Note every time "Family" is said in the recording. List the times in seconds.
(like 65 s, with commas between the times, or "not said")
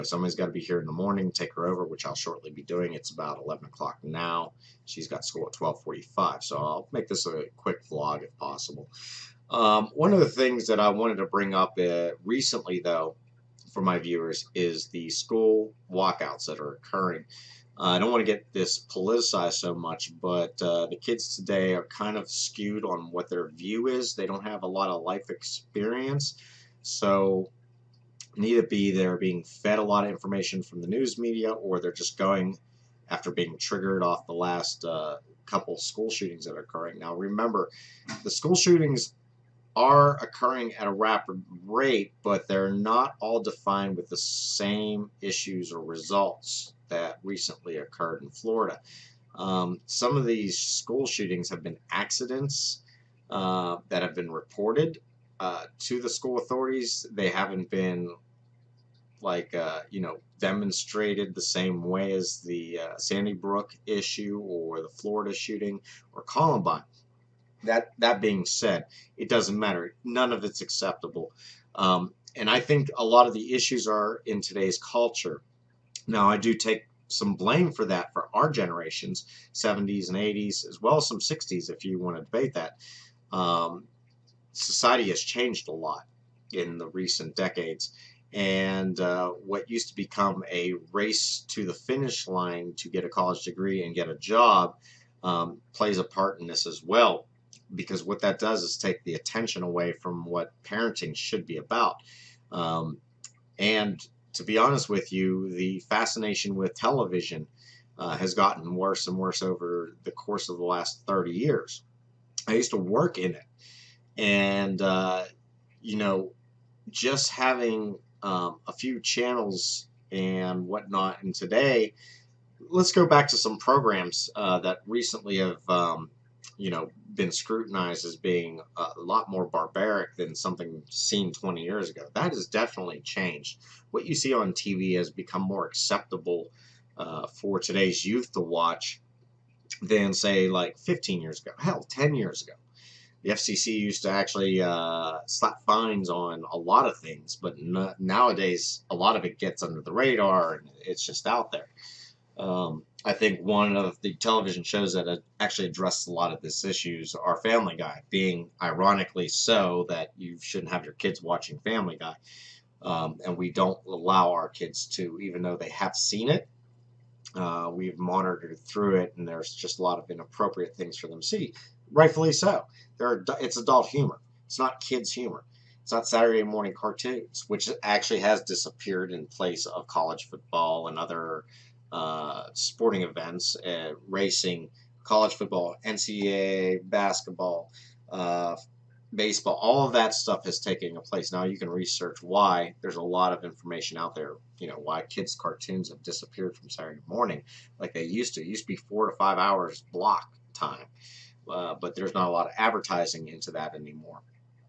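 157 s, 161 s.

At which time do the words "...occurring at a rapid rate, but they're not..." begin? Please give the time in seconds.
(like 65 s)
40 s.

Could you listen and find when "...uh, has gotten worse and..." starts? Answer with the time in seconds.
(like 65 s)
107 s.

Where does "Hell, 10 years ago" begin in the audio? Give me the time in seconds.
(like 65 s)
141 s.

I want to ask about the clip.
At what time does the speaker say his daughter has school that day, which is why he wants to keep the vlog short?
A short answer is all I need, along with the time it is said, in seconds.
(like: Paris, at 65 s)
12:45, at 5 s.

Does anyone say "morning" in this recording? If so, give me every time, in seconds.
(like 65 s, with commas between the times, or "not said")
0 s, 176 s, 197 s.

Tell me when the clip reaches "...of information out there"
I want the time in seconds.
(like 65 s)
193 s.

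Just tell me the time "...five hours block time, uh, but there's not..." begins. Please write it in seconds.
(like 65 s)
199 s.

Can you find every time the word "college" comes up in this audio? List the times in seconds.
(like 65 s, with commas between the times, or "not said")
93 s, 179 s, 185 s.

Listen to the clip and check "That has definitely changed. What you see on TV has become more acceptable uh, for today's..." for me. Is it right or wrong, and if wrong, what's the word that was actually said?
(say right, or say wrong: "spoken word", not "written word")
right.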